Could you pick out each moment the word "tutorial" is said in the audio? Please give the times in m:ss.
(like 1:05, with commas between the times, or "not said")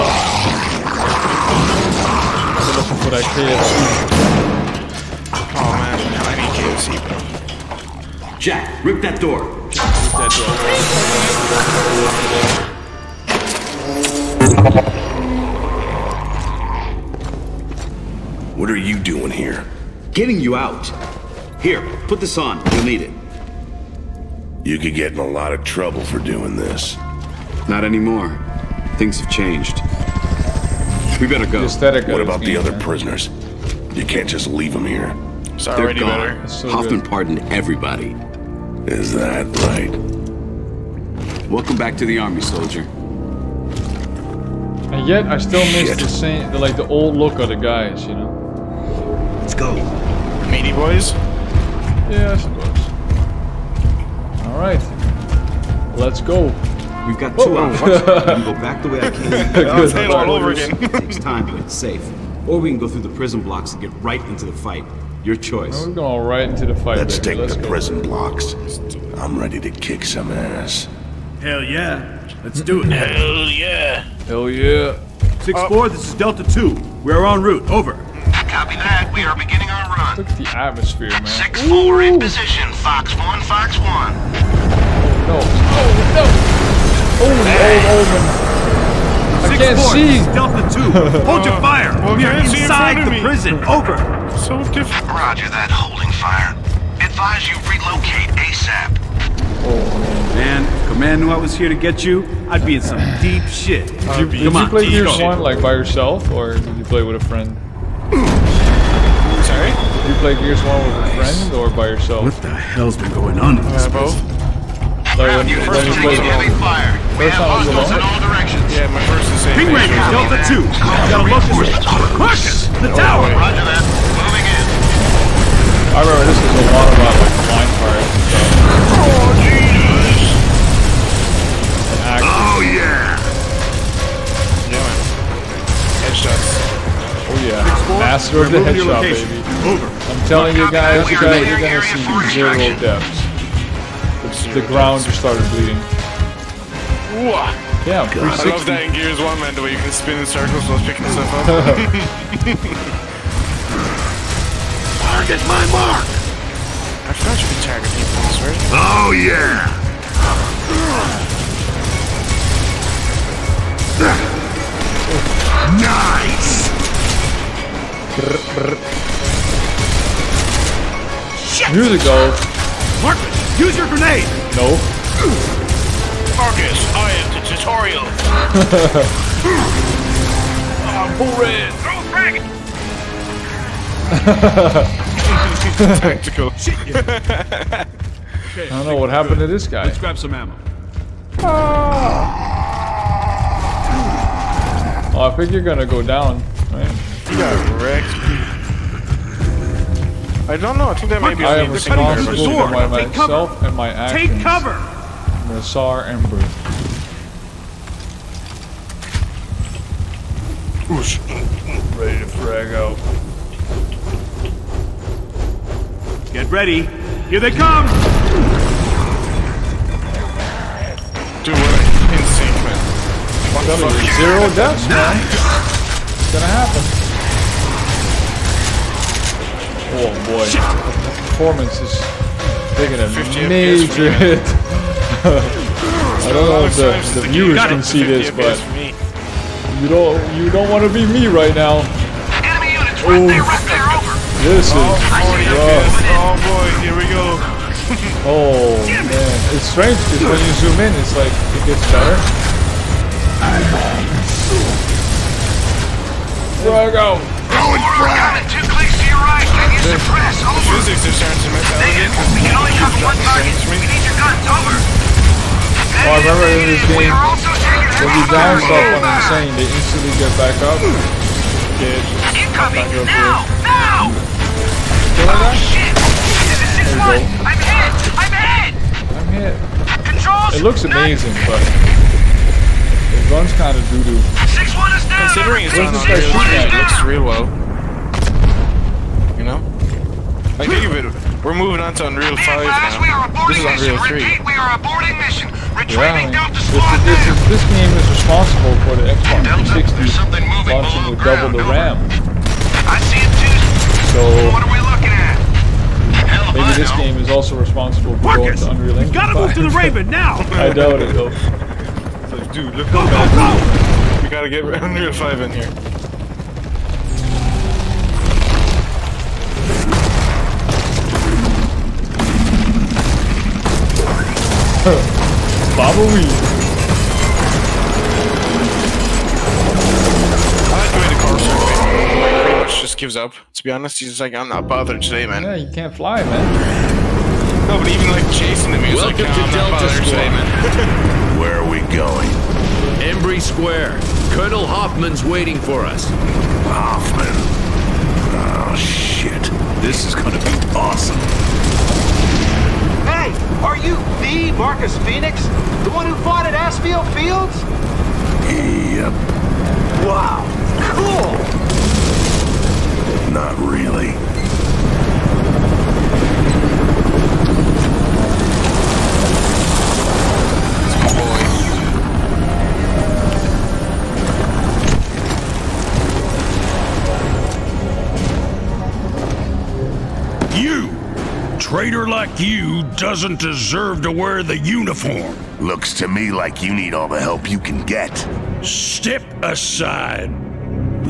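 2:57.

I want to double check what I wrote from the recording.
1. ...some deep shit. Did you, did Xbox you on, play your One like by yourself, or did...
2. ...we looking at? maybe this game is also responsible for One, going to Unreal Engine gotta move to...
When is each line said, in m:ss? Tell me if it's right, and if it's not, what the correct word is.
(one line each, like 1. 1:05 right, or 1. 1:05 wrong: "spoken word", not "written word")
1. 1:42 wrong: "Come", not "Xbox"
2. 5:04 wrong: "Marcus", not "One".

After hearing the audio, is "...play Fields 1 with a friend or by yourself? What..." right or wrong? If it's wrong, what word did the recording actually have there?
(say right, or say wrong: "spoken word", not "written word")
wrong: "Gears", not "Fields".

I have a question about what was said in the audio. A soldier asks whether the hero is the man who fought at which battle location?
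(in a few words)
Aspho Fields.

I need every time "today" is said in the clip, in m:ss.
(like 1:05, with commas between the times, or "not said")
5:35, 5:40.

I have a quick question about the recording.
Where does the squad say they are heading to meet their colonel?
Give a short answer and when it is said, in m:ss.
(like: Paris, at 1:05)
Embry Square, at 5:43.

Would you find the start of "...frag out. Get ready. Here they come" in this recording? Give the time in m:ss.
3:32.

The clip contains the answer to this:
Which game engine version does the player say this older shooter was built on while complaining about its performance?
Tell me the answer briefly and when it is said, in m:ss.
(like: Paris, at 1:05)
Unreal 3, at 4:53.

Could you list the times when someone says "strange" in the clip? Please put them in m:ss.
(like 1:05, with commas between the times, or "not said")
4:09.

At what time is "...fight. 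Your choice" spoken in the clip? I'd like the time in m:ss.
1:04.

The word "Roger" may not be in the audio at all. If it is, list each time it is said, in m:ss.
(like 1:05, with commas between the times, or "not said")
1:35, 2:03.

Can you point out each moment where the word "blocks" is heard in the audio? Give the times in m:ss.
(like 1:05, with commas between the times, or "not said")
1:03, 1:08.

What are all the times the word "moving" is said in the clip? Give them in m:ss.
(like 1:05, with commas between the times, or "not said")
2:04, 4:51.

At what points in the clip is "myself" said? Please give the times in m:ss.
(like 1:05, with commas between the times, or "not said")
3:22.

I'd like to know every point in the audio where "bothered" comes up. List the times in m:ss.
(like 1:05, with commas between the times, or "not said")
5:34.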